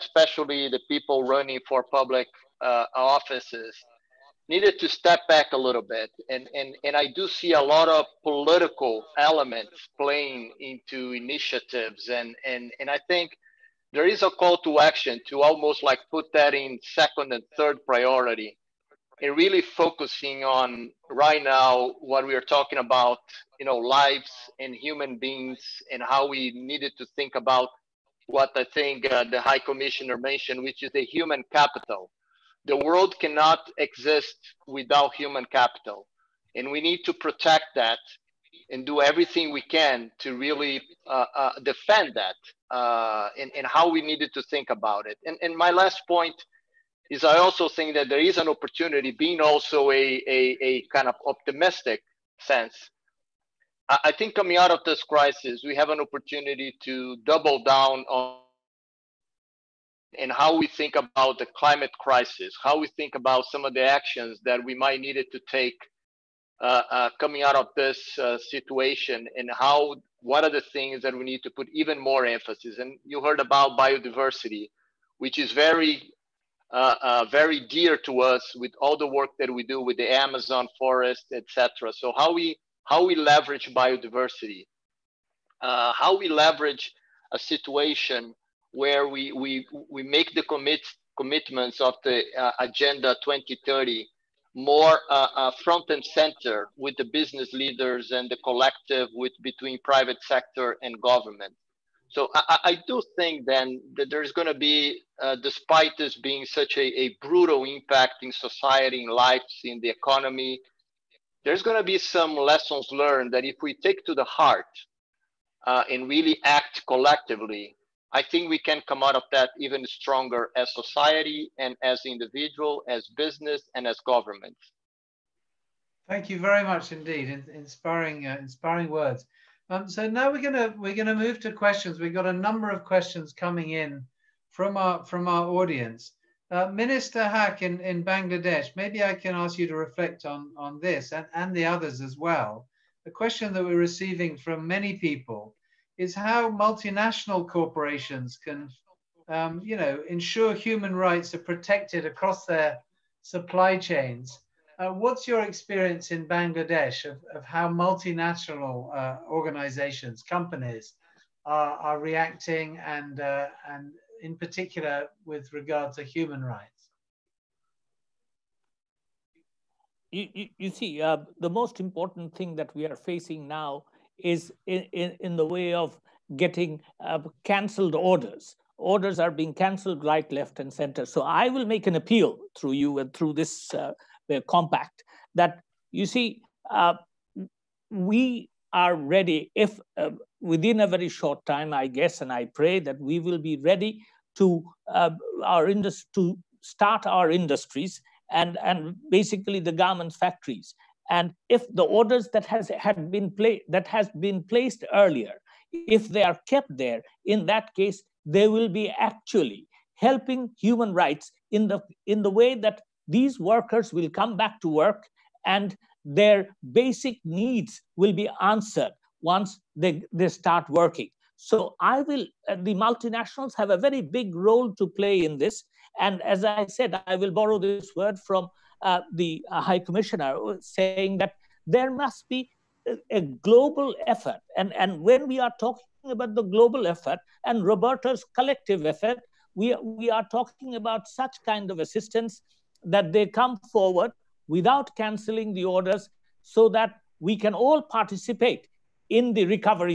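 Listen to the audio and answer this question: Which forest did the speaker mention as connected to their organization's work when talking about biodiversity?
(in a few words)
Amazon forest.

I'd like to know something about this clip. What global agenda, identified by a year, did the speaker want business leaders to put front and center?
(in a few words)
Agenda 2030.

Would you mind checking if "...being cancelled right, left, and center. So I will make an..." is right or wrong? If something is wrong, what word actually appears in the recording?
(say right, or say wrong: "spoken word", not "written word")
right.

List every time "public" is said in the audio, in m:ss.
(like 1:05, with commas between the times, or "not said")
0:01.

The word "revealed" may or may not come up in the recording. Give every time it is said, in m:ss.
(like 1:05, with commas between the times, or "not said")
not said.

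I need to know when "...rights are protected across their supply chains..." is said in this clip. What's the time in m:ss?
2:30.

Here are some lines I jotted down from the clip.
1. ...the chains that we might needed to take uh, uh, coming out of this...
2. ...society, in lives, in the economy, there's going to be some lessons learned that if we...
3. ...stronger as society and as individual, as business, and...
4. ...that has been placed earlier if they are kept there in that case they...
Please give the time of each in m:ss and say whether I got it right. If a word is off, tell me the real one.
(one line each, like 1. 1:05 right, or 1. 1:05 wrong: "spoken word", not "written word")
1. 1:03 wrong: "actions", not "chains"
2. 1:48 right
3. 1:59 right
4. 3:23 right.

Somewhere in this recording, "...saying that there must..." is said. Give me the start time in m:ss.
3:50.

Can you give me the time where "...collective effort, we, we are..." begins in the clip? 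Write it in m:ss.
3:58.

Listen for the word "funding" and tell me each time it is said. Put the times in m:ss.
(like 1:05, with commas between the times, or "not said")
not said.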